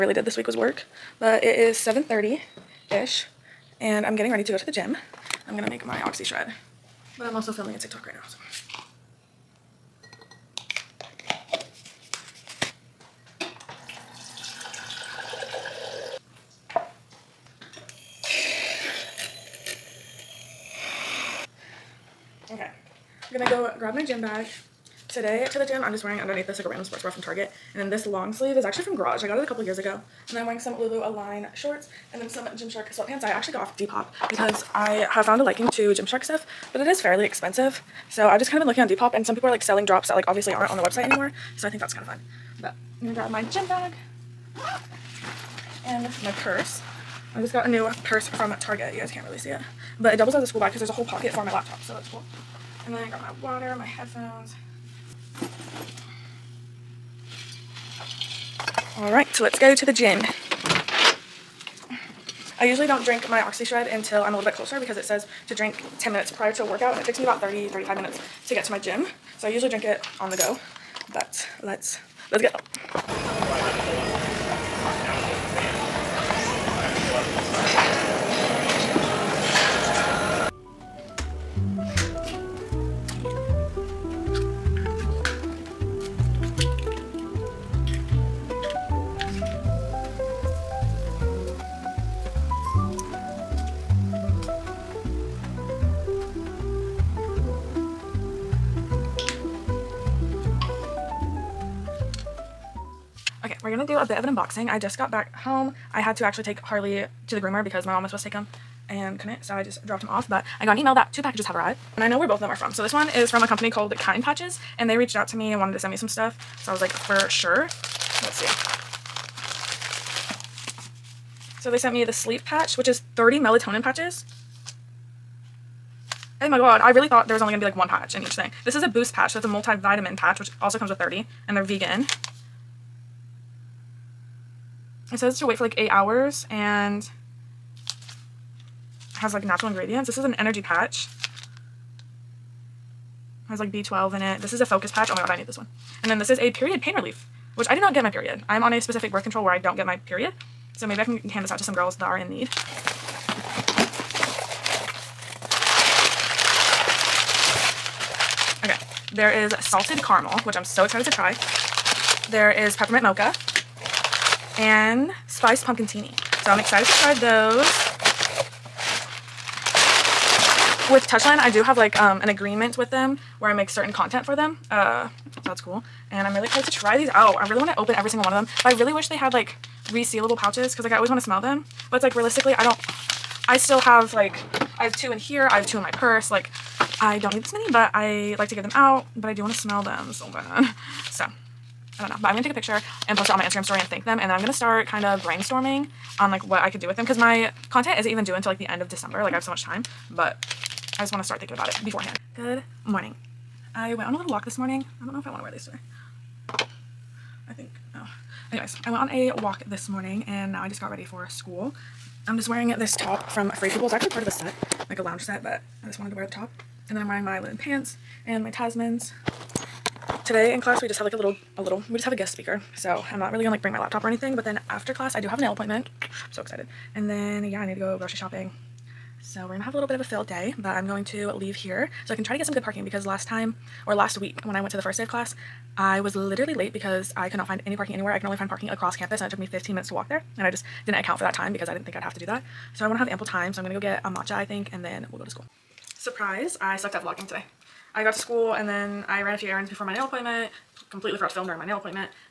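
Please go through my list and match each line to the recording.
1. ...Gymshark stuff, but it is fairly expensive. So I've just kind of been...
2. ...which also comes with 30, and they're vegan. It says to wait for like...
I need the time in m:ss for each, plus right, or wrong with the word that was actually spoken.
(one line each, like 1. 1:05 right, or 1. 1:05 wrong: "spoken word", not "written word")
1. 0:35 right
2. 2:10 right.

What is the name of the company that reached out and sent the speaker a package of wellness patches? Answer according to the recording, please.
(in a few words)
Kind Patches.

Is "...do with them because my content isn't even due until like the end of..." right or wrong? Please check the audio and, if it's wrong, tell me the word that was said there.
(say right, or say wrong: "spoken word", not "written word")
right.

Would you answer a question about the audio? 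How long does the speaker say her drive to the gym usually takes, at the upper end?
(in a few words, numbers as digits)
35 minutes.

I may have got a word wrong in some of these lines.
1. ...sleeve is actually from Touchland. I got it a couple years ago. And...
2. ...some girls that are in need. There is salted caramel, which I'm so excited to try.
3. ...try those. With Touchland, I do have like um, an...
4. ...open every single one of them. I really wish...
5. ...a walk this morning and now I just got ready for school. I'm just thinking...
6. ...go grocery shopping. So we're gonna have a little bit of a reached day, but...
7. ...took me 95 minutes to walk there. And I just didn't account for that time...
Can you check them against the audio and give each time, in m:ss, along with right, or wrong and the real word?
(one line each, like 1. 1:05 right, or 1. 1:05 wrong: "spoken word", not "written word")
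1. 0:28 wrong: "Garage", not "Touchland"
2. 2:31 right
3. 2:47 right
4. 2:57 right
5. 3:29 wrong: "wearing", not "thinking"
6. 3:47 wrong: "filled", not "reached"
7. 3:59 wrong: "15", not "95".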